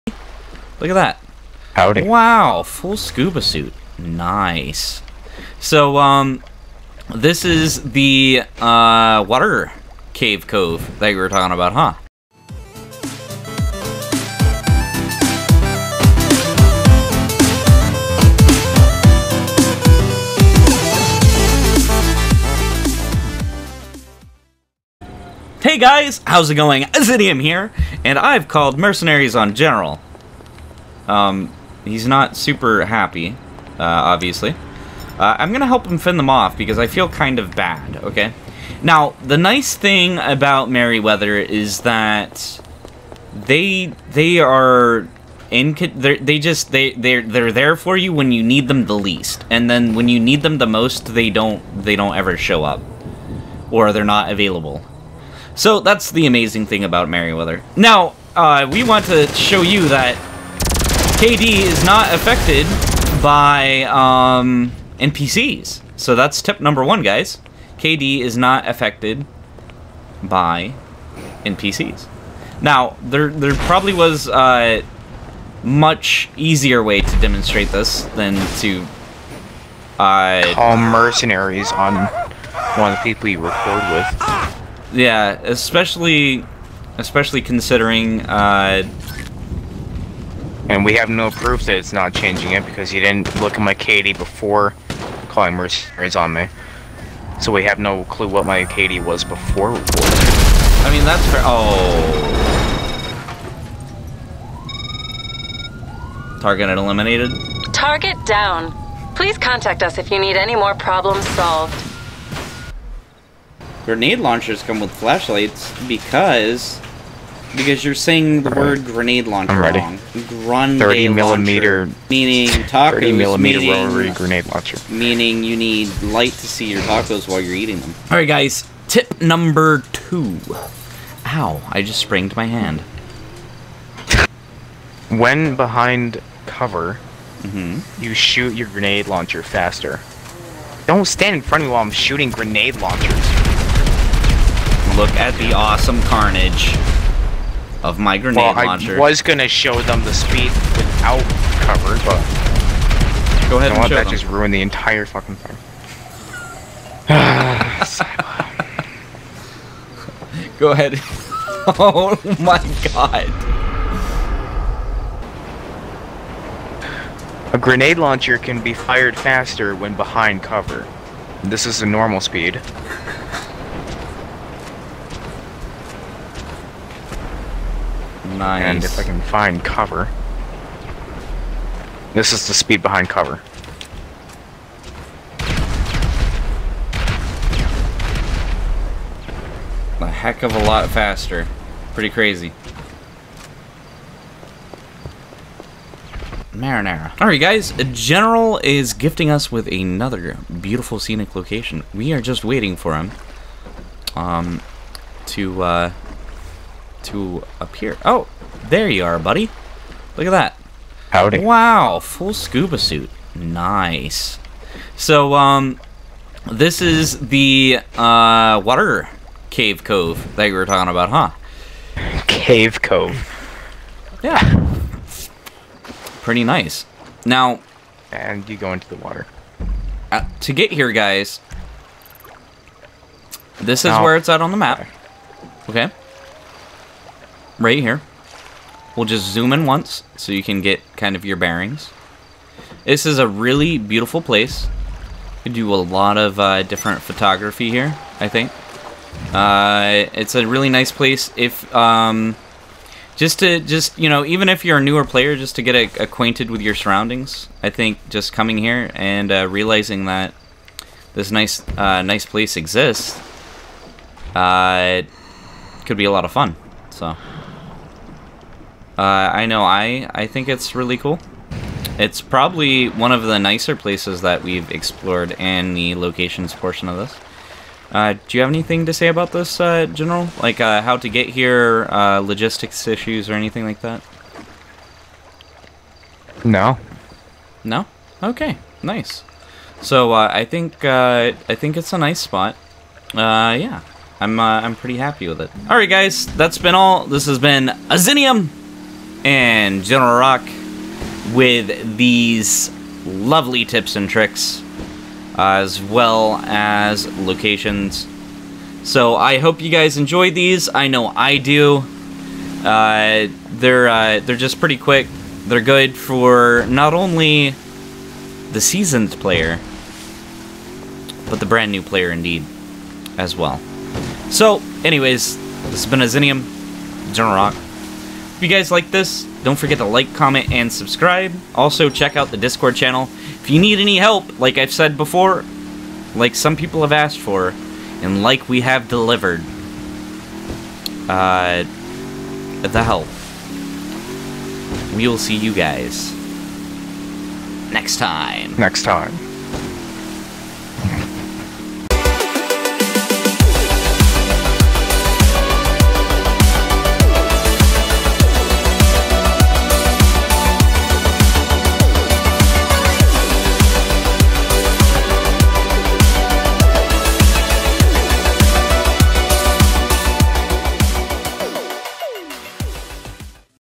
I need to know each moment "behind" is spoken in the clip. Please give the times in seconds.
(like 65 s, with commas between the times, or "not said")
135 s, 169 s, 182 s.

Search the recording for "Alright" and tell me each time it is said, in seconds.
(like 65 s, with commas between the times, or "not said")
128 s, 197 s.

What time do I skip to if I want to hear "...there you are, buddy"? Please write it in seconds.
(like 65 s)
208 s.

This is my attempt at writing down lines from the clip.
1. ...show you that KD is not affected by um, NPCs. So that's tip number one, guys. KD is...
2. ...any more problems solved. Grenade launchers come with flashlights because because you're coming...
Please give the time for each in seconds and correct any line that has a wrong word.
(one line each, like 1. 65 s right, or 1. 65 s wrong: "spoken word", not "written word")
1. 59 s right
2. 110 s wrong: "saying", not "coming".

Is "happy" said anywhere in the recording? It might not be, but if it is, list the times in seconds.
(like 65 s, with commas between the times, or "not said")
32 s, 294 s.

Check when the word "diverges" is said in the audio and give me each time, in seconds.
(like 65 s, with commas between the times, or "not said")
not said.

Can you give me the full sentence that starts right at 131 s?
Ow, I just sprained my hand.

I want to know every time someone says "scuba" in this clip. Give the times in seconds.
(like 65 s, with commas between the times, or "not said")
2 s, 212 s.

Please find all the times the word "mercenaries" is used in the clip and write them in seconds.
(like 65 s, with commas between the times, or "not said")
28 s, 80 s, 95 s.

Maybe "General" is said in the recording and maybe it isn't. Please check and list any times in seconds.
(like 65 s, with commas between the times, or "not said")
29 s, 197 s, 279 s, 299 s, 327 s.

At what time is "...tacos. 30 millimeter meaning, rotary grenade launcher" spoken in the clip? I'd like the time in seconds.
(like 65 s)
122 s.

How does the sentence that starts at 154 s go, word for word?
just ruin the entire fucking thing.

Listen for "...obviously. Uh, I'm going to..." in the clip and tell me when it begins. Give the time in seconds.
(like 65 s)
33 s.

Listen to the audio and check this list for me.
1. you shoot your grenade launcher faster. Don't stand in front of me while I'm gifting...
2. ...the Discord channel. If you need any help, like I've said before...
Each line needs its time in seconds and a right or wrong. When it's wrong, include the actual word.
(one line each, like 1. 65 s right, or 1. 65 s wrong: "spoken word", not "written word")
1. 138 s wrong: "shooting", not "gifting"
2. 332 s right.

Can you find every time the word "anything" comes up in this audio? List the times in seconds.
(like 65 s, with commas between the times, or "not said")
278 s, 283 s.